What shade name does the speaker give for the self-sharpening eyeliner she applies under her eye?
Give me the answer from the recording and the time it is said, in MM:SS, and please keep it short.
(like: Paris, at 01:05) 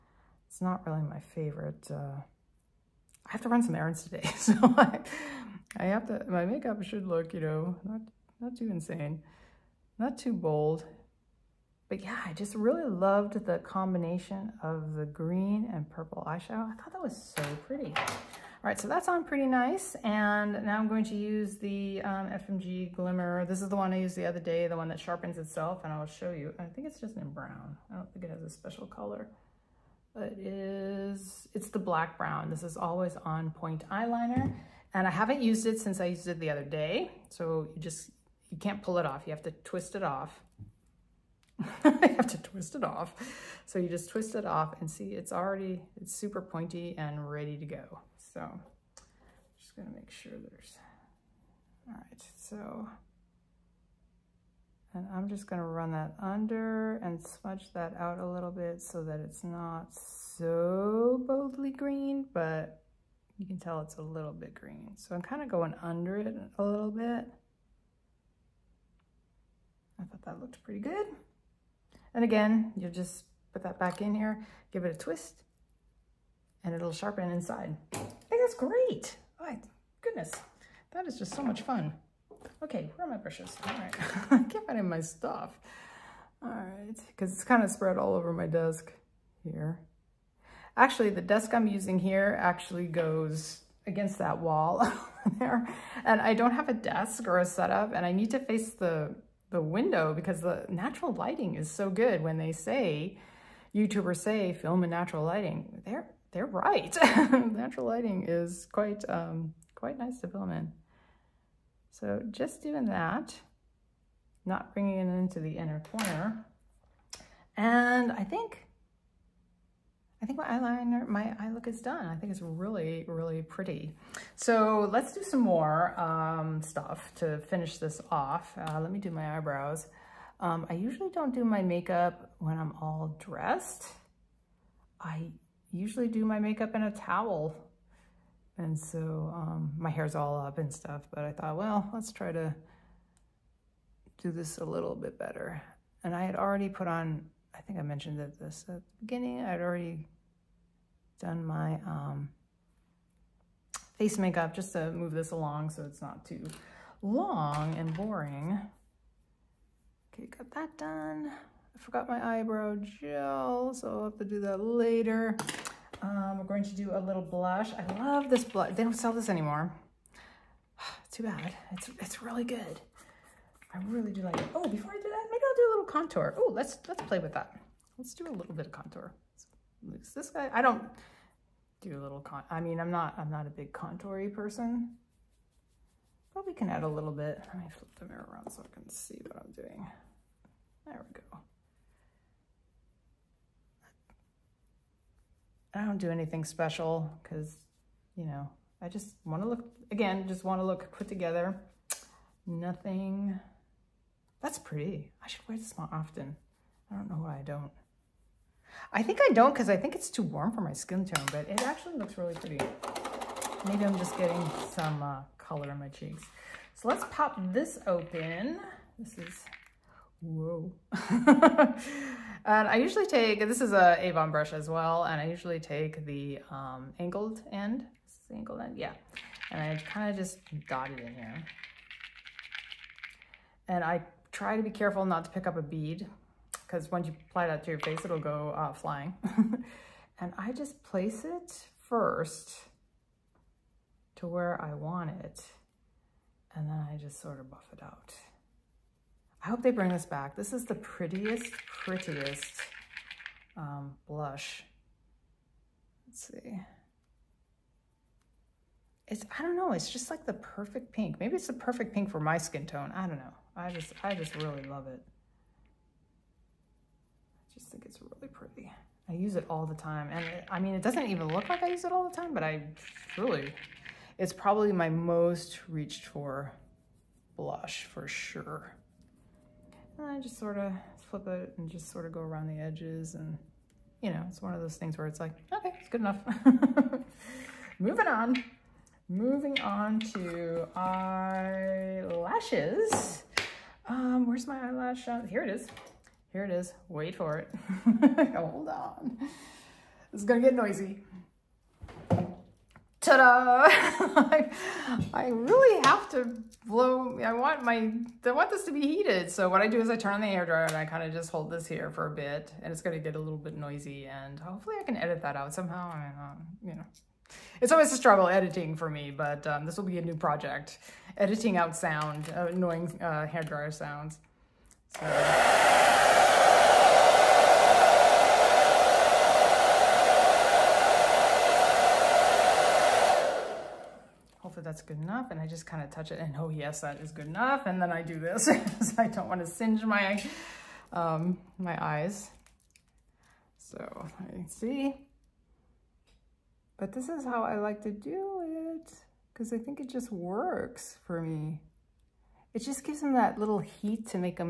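black brown, at 00:31.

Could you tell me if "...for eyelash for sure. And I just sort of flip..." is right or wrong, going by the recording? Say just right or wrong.
wrong.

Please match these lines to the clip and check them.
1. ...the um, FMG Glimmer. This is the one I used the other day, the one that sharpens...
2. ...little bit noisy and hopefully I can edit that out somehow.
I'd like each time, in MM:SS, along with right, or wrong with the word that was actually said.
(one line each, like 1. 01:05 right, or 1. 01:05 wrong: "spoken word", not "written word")
1. 00:21 right
2. 05:13 right.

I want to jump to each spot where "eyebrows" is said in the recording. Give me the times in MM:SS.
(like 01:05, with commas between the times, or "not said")
02:09, 02:42.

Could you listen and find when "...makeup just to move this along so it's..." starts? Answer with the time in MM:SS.
02:34.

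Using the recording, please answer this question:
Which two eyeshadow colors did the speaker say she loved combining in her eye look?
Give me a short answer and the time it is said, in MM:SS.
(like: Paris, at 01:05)
green and purple, at 00:15.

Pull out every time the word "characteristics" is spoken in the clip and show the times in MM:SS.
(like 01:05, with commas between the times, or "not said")
not said.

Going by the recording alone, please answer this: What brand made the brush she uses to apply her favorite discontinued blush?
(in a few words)
Avon.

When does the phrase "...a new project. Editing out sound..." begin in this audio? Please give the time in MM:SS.
05:19.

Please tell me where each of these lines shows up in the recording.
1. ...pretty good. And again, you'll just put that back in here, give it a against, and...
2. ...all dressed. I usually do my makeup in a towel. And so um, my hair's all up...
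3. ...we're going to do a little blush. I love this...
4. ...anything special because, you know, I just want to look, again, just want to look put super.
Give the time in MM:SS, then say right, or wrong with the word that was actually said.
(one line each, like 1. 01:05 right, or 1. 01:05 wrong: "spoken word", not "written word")
1. 01:10 wrong: "twist", not "against"
2. 02:12 right
3. 02:46 right
4. 03:16 wrong: "together", not "super".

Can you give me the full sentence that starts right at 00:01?
Uh, I have to run some errands today.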